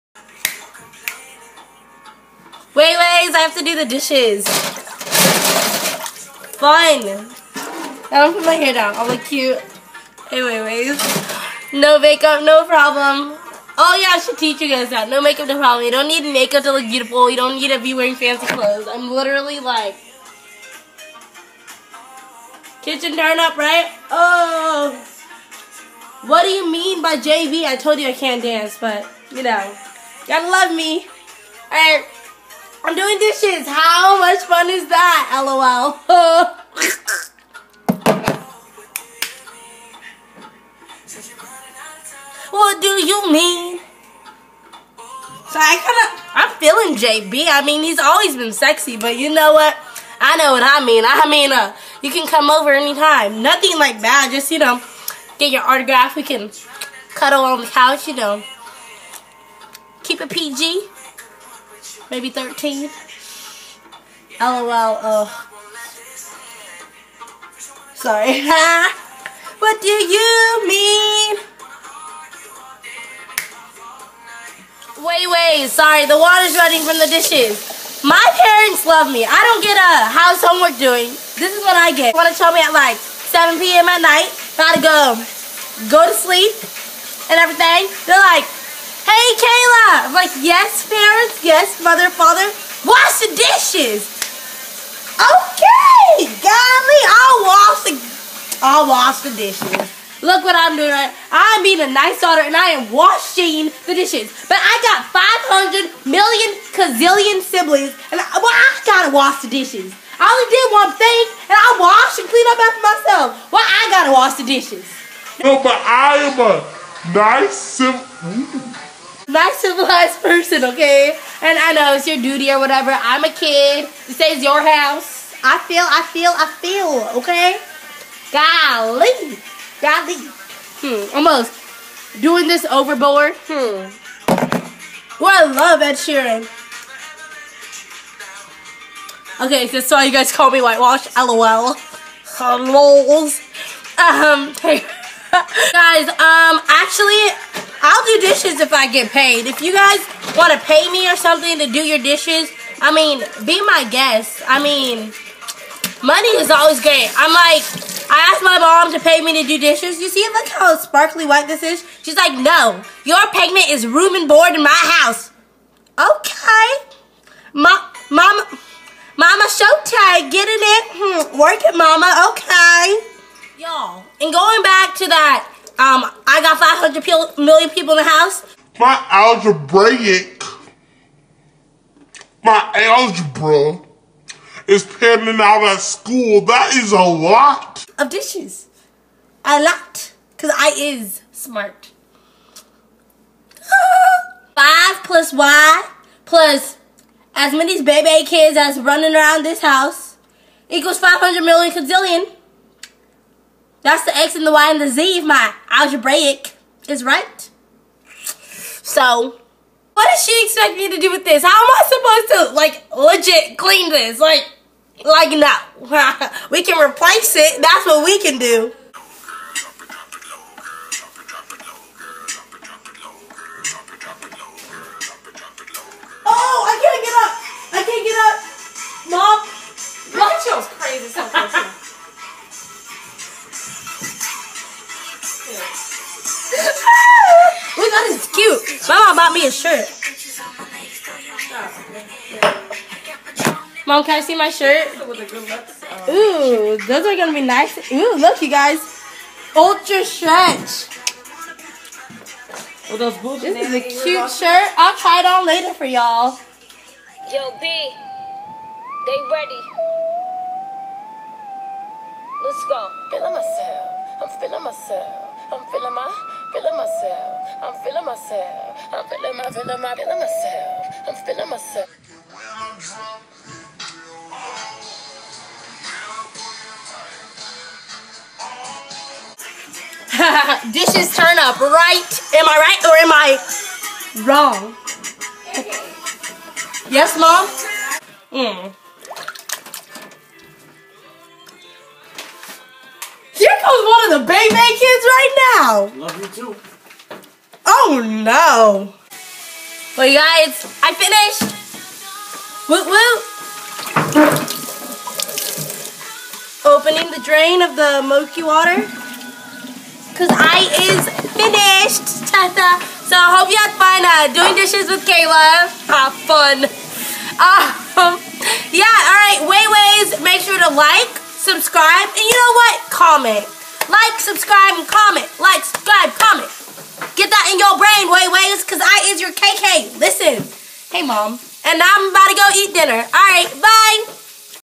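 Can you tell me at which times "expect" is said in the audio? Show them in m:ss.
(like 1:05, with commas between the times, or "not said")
3:30.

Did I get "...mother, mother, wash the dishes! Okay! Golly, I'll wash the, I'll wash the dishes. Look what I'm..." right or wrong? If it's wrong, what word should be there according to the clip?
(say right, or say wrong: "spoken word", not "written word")
wrong: "father", not "mother".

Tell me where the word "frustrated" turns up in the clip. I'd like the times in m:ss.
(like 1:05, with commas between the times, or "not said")
not said.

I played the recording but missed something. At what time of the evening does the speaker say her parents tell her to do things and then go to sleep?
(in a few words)
7 p.m.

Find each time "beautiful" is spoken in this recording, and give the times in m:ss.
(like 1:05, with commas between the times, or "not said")
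0:16.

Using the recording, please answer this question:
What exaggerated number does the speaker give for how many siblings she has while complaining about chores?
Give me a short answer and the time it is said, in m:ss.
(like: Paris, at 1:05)
500 million kazillion, at 1:45.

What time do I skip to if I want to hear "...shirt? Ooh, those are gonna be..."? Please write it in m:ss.
4:04.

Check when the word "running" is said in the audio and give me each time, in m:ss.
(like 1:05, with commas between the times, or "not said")
1:16, 3:18.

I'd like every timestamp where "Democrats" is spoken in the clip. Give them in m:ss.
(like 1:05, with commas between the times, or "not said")
not said.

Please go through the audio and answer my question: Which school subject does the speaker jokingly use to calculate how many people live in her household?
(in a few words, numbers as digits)
Algebra.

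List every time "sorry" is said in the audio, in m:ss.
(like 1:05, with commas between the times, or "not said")
1:07, 1:15.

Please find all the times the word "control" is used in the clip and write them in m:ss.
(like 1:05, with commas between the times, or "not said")
not said.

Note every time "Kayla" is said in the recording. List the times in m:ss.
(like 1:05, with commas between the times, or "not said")
1:29, 5:15.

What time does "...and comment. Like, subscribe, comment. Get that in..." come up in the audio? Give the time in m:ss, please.
5:24.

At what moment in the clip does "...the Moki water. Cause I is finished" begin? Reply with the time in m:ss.
5:07.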